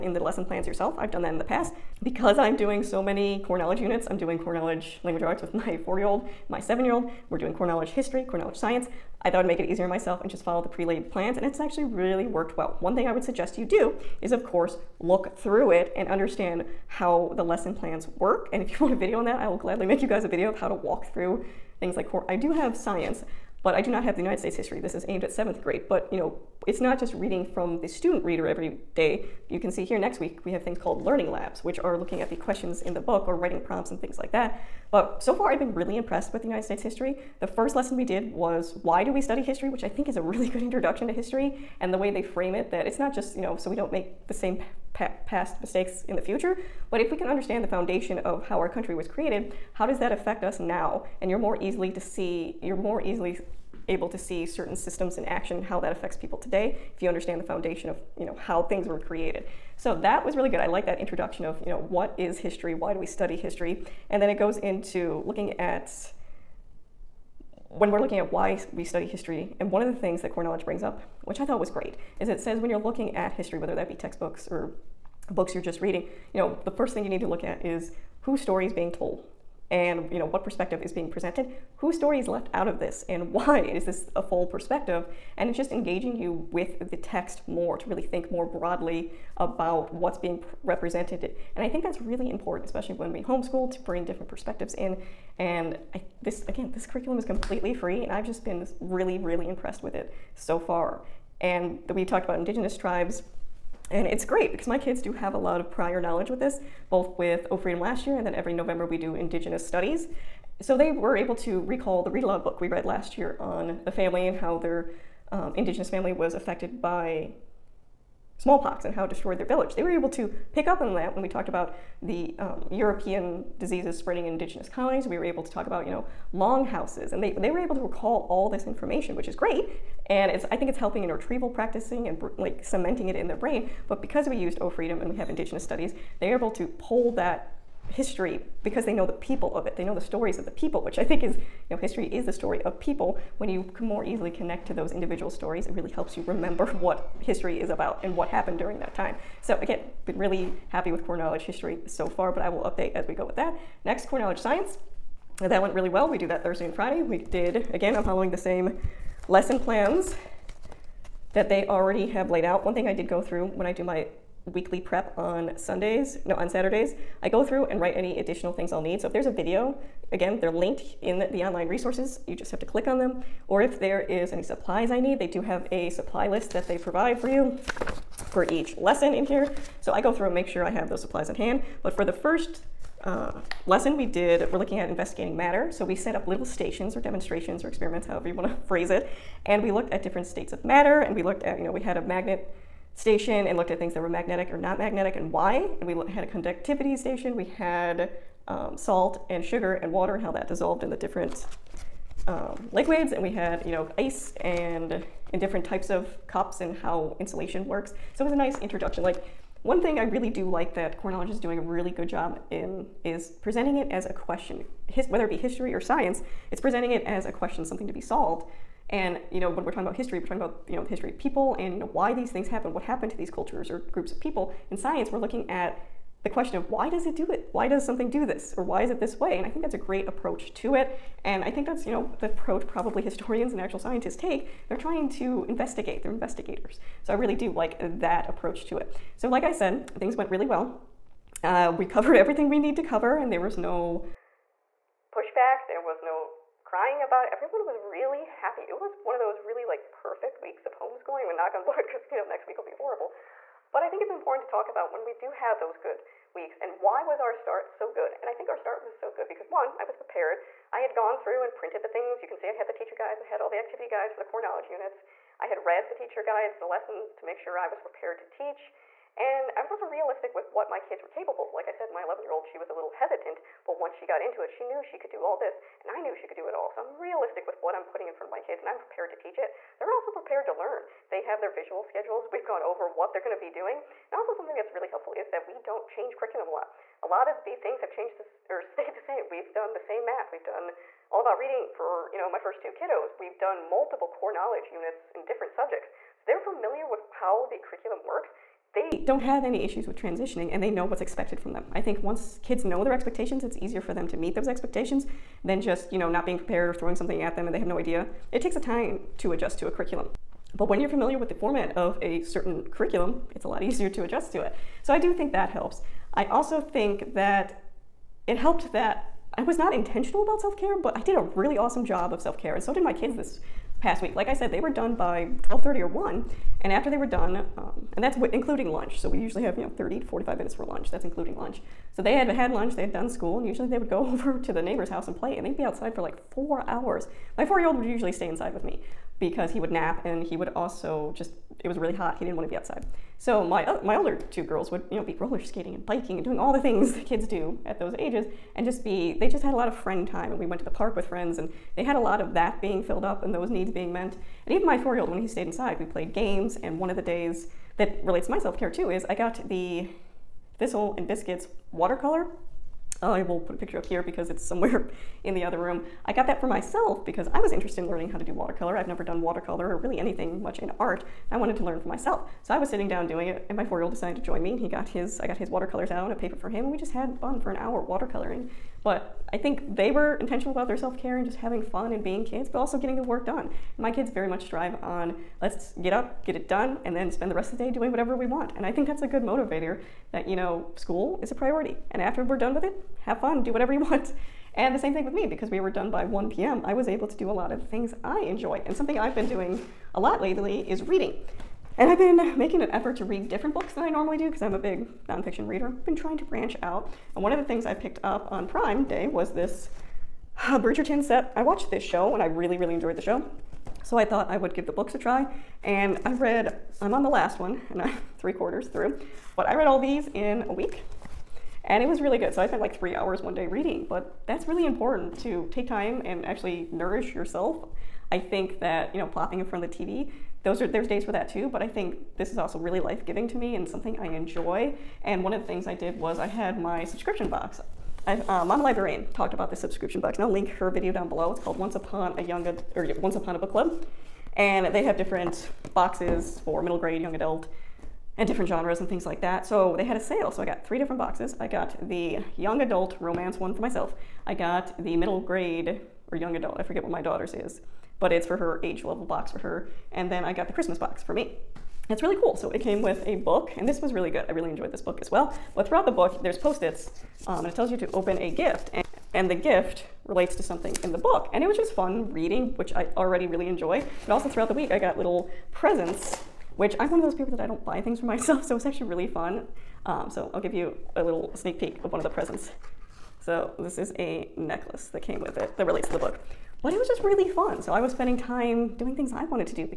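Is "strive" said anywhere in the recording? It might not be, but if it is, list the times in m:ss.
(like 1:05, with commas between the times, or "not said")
6:24.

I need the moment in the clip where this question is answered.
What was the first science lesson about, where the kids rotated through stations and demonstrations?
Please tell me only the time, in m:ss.
3:04.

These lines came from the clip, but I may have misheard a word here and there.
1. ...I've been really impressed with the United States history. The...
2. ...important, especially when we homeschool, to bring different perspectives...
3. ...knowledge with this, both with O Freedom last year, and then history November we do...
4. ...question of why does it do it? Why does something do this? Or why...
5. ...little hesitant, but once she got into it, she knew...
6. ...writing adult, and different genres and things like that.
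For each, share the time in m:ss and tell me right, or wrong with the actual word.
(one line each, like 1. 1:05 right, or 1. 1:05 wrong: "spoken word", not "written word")
1. 0:35 right
2. 1:32 right
3. 1:46 wrong: "every", not "history"
4. 3:46 right
5. 4:32 right
6. 7:27 wrong: "young", not "writing".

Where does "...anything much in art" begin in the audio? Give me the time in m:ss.
6:09.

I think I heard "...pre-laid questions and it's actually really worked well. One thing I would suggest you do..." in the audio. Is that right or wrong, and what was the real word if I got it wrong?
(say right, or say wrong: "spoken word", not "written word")
wrong: "plans", not "questions".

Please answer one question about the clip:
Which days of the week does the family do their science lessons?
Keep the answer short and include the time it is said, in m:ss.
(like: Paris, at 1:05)
Thursday and Friday, at 2:36.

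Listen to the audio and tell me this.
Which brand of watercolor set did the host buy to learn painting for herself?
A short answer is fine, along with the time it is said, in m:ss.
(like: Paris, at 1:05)
Thistle and Biscuits, at 6:00.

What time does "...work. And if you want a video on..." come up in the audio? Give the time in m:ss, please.
0:18.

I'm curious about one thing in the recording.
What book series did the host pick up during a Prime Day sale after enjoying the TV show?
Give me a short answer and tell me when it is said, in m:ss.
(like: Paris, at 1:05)
Bridgerton, at 6:50.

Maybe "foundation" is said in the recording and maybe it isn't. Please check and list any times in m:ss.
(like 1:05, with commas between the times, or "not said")
0:47, 0:57.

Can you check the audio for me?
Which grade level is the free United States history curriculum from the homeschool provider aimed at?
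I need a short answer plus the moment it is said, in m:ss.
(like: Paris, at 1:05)
7th grade, at 0:25.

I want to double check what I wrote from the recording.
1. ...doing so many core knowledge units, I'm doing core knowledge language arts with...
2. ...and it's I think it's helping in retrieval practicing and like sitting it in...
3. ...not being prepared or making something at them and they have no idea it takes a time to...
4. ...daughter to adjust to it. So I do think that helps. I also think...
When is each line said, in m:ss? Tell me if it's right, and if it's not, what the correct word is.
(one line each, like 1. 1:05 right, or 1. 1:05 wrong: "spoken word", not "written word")
1. 0:02 right
2. 2:10 wrong: "cementing", not "sitting"
3. 5:06 wrong: "throwing", not "making"
4. 5:13 wrong: "easier", not "daughter".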